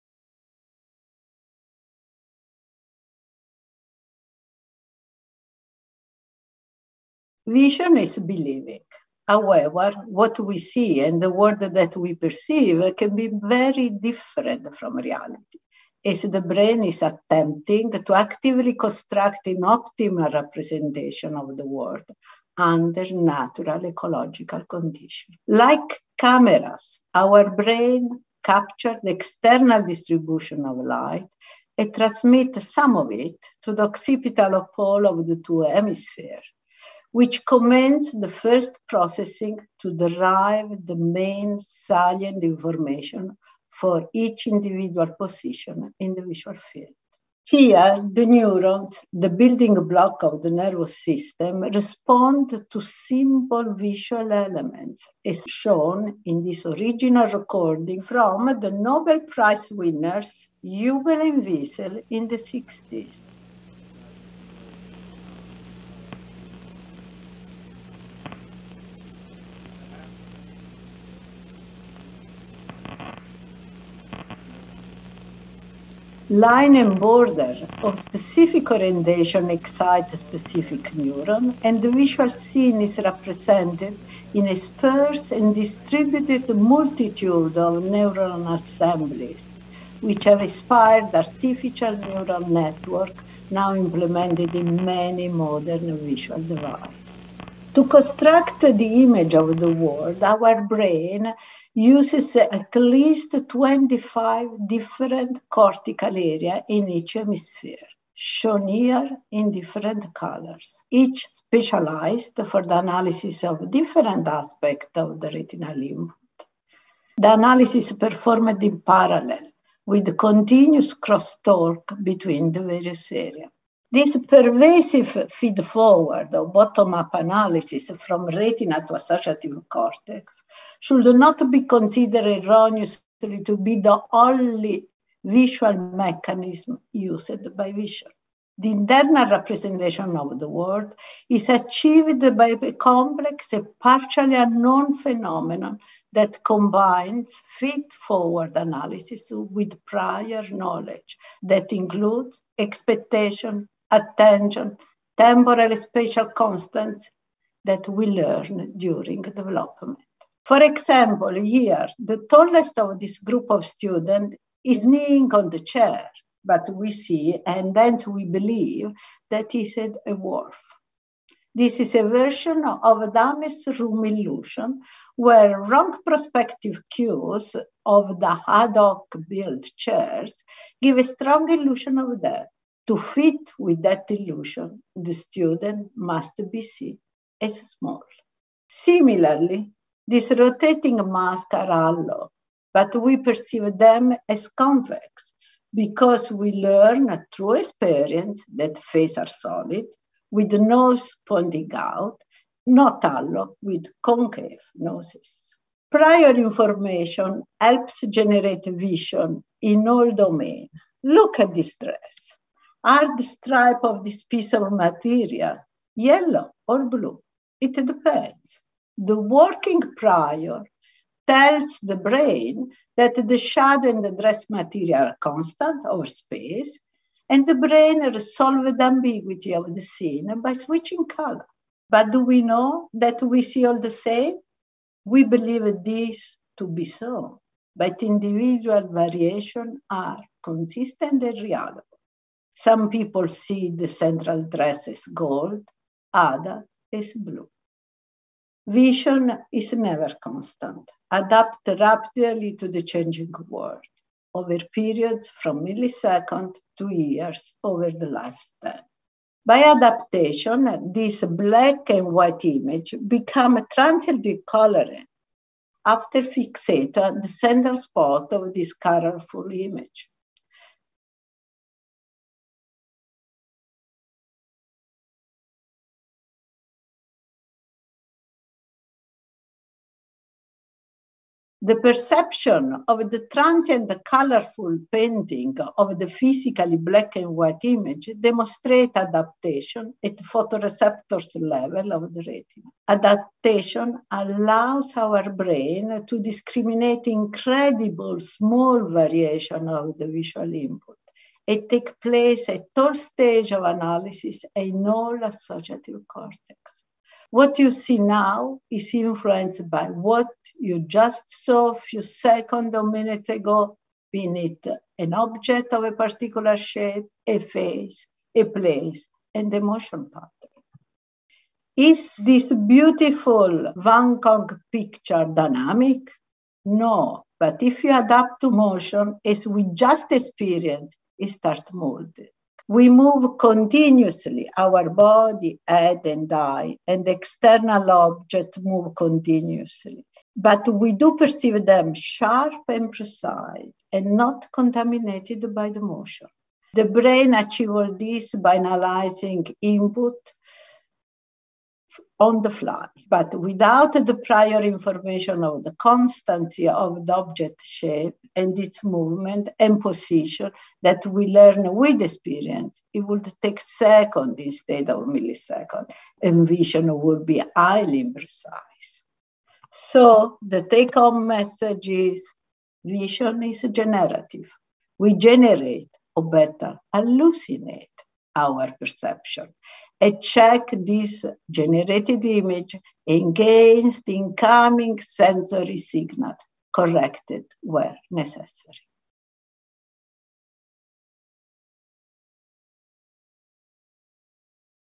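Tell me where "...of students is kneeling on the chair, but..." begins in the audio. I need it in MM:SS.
02:43.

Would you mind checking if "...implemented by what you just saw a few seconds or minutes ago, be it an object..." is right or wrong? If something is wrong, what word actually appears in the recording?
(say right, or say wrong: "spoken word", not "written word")
wrong: "influenced", not "implemented".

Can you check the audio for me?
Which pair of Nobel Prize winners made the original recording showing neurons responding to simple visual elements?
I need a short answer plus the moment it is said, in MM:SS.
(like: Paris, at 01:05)
Hubel and Wiesel, at 01:00.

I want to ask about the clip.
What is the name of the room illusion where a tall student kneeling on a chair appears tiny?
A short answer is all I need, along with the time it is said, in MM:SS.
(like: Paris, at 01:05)
Adame's room, at 02:53.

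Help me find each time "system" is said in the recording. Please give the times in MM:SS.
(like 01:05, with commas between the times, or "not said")
00:51.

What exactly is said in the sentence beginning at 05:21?
Is this beautiful Van Gogh picture dynamic?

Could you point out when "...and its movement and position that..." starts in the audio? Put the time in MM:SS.
05:58.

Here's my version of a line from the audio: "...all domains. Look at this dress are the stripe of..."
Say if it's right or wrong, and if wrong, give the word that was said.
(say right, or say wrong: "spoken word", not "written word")
right.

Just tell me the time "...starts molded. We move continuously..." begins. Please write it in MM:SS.
05:31.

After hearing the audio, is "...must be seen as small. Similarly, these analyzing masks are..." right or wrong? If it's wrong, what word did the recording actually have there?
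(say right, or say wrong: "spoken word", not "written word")
wrong: "rotating", not "analyzing".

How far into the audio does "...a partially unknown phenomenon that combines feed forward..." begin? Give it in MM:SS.
02:23.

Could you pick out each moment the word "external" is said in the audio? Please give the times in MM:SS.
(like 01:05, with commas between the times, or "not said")
00:29, 05:37.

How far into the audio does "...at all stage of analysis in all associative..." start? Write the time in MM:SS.
05:02.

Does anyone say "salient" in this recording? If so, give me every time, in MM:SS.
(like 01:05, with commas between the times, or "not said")
00:41.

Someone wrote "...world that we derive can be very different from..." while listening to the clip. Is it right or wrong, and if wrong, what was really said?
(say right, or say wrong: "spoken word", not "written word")
wrong: "perceive", not "derive".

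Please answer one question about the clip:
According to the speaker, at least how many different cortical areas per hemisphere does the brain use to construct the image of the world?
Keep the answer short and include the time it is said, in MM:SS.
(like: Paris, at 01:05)
25, at 01:43.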